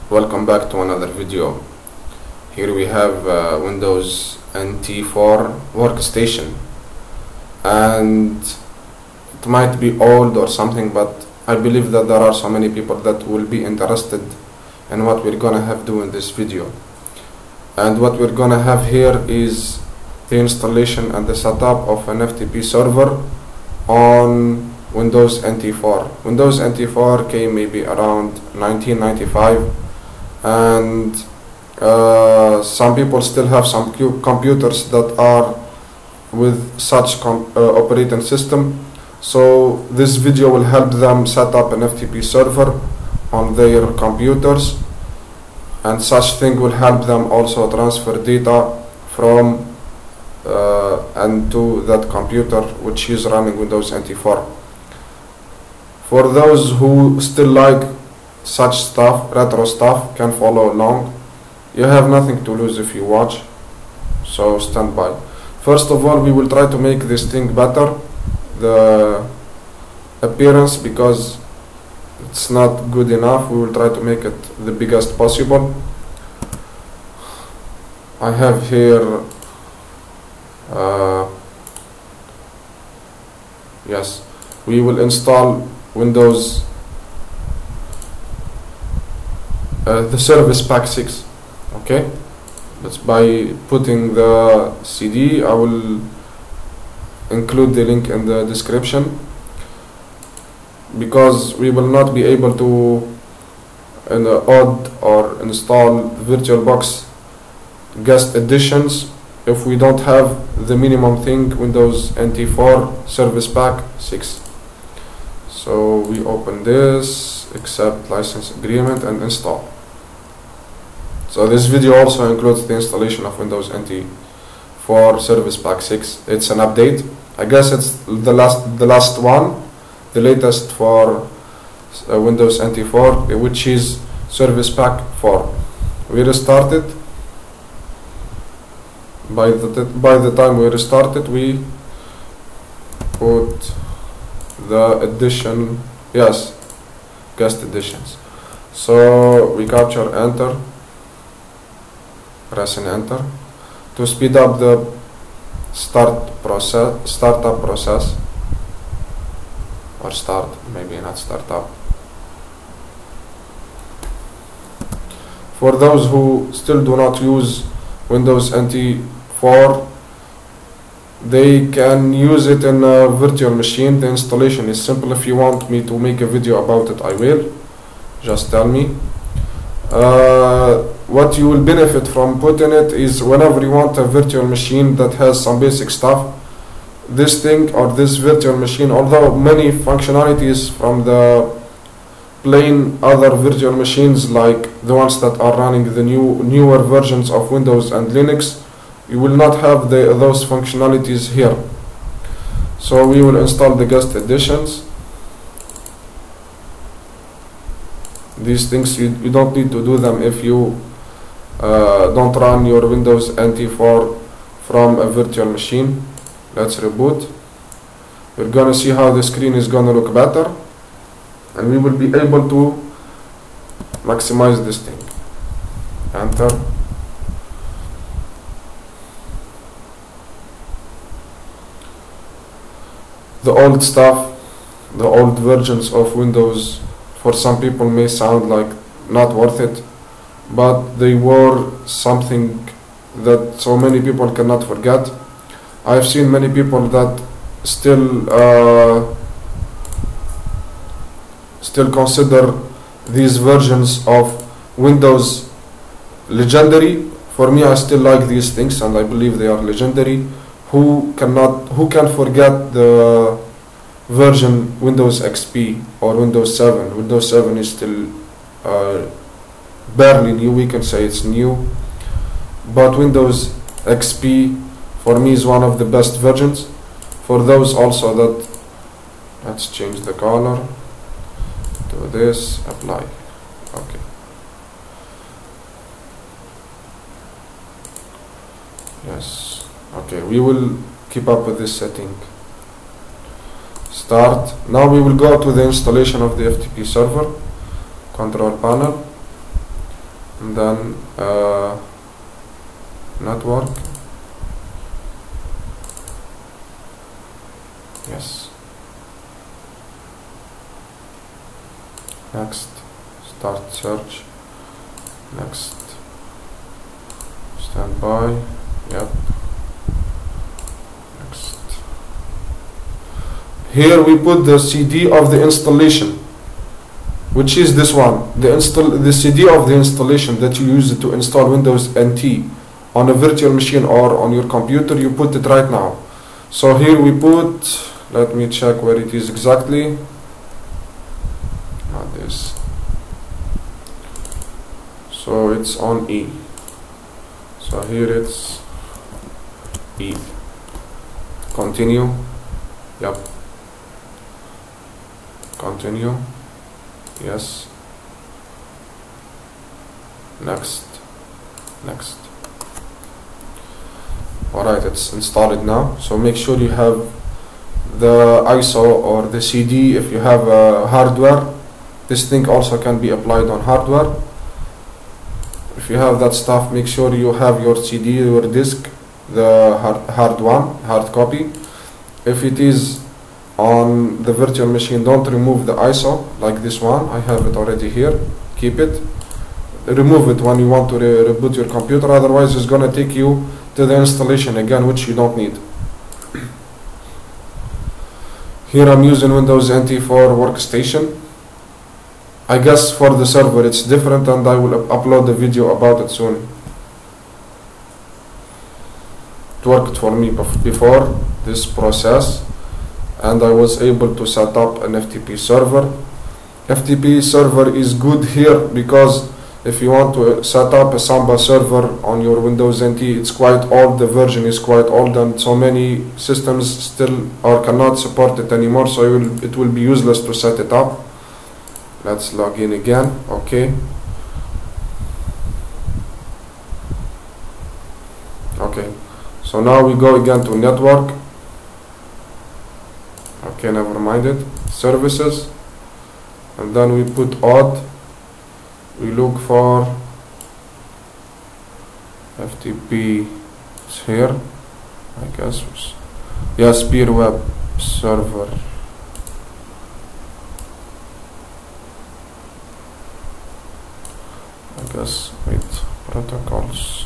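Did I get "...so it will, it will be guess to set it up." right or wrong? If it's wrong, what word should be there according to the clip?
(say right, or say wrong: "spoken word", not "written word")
wrong: "useless", not "guess".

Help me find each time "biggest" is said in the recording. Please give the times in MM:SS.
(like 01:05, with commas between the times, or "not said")
01:14.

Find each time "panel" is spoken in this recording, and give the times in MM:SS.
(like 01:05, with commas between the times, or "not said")
04:58.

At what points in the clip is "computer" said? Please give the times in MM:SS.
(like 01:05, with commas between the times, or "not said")
00:34, 00:43, 00:52, 05:34, 06:31.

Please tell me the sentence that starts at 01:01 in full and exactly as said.
You have nothing to lose if you watch, so stand by.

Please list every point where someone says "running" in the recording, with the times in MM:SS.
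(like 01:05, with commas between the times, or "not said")
00:53, 03:15.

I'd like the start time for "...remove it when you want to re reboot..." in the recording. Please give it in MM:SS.
06:29.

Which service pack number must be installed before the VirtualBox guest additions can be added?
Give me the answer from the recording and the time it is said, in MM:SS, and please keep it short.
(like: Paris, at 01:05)
6, at 01:30.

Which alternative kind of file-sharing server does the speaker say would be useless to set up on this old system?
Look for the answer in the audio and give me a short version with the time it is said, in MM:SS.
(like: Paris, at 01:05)
Samba server, at 07:00.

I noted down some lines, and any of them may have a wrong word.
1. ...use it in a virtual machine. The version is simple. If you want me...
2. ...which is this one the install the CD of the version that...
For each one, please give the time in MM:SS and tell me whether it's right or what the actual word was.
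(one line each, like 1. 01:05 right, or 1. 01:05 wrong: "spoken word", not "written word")
1. 02:52 wrong: "installation", not "version"
2. 05:27 wrong: "installation", not "version".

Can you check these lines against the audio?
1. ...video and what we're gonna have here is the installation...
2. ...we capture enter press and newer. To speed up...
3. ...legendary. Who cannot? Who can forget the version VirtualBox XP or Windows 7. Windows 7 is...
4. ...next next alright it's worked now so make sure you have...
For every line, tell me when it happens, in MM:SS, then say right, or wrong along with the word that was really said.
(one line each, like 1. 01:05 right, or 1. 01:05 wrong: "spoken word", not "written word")
1. 00:16 right
2. 02:29 wrong: "enter", not "newer"
3. 04:19 wrong: "Windows", not "VirtualBox"
4. 06:00 wrong: "installed", not "worked".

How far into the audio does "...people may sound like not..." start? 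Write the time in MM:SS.
03:57.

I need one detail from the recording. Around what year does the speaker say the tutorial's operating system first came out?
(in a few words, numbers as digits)
1995.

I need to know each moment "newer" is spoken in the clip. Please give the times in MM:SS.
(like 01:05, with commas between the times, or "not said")
03:16.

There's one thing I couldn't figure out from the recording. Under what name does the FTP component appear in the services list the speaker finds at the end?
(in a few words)
Peer Web Server.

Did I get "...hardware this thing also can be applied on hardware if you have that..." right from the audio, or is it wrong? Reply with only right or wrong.
right.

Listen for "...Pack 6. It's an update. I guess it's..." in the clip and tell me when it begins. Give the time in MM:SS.
02:05.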